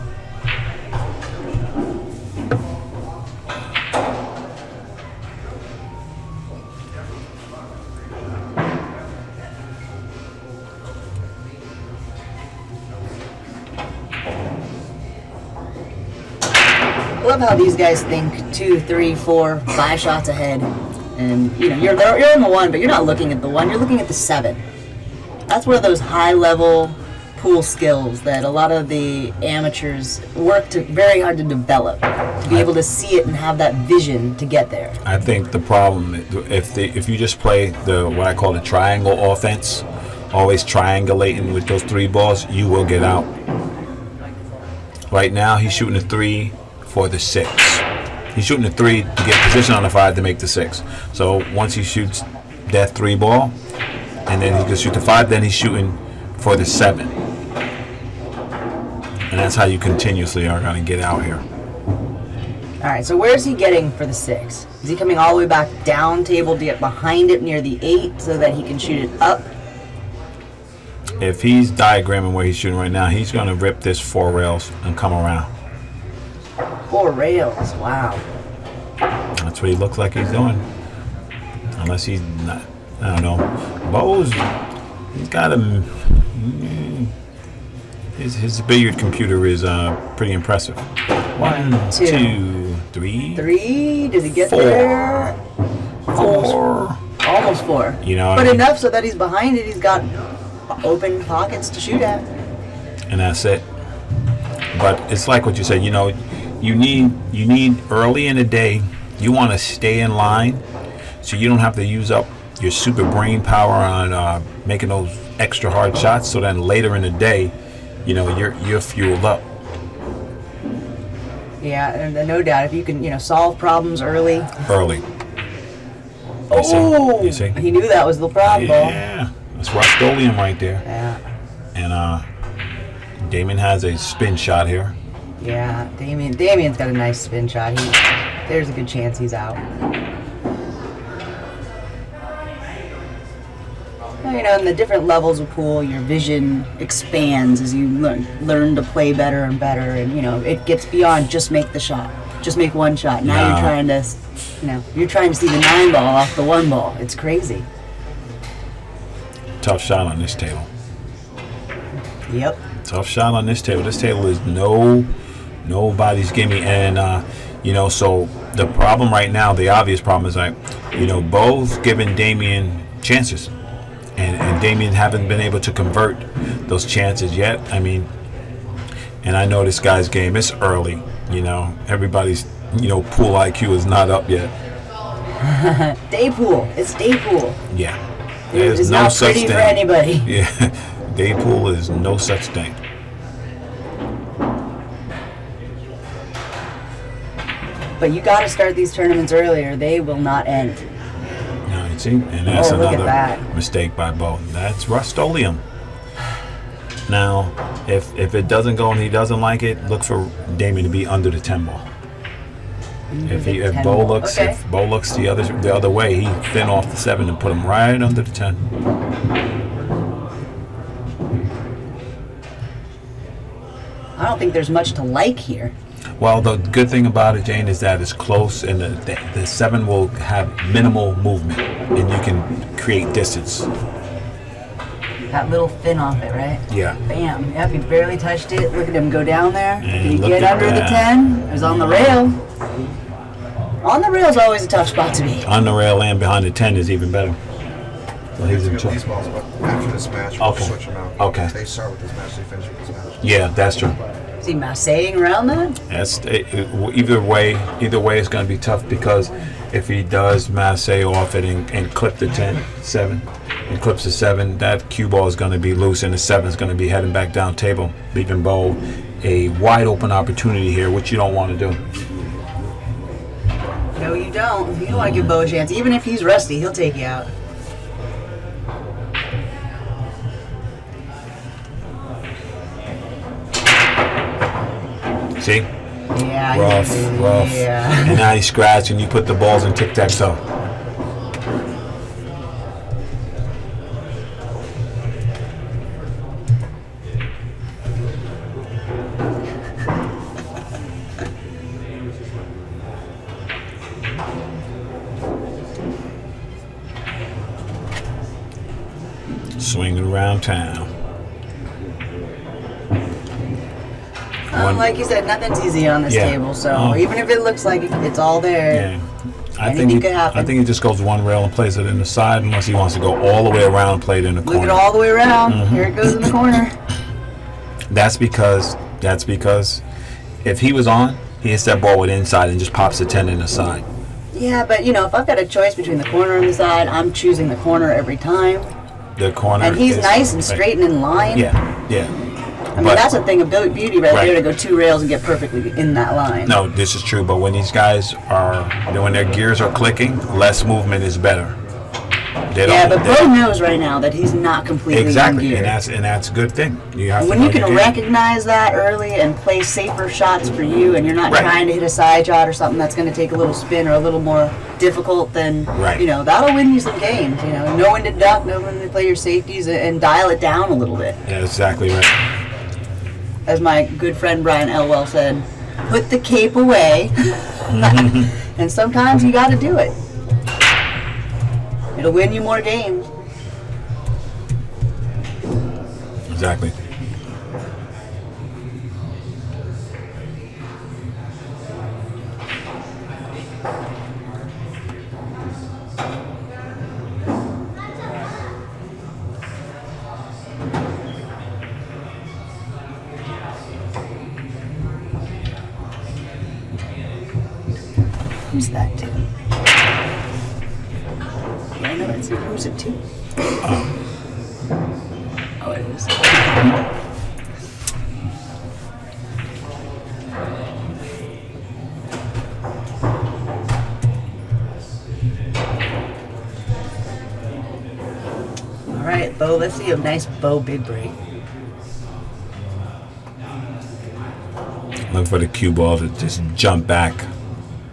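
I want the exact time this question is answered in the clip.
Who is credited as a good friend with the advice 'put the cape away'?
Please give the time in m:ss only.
6:14.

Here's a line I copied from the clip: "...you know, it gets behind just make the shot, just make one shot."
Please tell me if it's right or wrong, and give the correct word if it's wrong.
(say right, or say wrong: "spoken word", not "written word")
wrong: "beyond", not "behind".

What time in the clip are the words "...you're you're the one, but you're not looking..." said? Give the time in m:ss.
0:21.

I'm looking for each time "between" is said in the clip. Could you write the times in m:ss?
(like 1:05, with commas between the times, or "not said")
5:35.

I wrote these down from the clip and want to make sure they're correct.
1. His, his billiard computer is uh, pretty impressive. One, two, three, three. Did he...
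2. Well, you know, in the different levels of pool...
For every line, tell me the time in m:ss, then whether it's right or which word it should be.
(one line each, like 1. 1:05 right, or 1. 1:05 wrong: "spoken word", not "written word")
1. 1:28 right
2. 2:24 right.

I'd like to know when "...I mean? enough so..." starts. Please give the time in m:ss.
1:38.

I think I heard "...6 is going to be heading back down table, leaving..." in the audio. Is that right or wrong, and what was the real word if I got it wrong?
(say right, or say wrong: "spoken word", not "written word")
wrong: "7", not "6".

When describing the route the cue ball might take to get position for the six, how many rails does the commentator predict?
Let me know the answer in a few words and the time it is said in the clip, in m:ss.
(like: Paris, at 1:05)
4, at 1:13.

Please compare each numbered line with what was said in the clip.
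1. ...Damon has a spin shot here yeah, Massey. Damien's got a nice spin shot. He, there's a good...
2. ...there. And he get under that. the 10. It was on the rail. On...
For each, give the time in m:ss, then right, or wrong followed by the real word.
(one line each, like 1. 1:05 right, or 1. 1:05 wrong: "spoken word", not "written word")
1. 2:13 wrong: "Damien", not "Massey"
2. 3:59 right.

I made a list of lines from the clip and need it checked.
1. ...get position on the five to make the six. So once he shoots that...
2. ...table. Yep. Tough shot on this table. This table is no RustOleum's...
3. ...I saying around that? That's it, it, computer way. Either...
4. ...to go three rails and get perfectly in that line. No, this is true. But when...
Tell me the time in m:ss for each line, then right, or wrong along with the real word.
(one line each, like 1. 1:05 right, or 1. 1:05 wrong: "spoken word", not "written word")
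1. 0:49 right
2. 2:40 wrong: "Nobody", not "RustOleum"
3. 4:14 wrong: "either", not "computer"
4. 5:44 wrong: "two", not "three".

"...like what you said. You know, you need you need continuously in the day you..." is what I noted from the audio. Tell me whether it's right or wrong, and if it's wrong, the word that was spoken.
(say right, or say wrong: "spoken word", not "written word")
wrong: "early", not "continuously".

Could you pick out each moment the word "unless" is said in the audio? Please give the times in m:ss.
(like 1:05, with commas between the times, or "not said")
1:21, 5:22.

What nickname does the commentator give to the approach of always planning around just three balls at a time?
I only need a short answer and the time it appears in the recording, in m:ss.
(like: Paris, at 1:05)
triangle offense, at 0:38.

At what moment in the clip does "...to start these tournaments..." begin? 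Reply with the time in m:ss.
3:18.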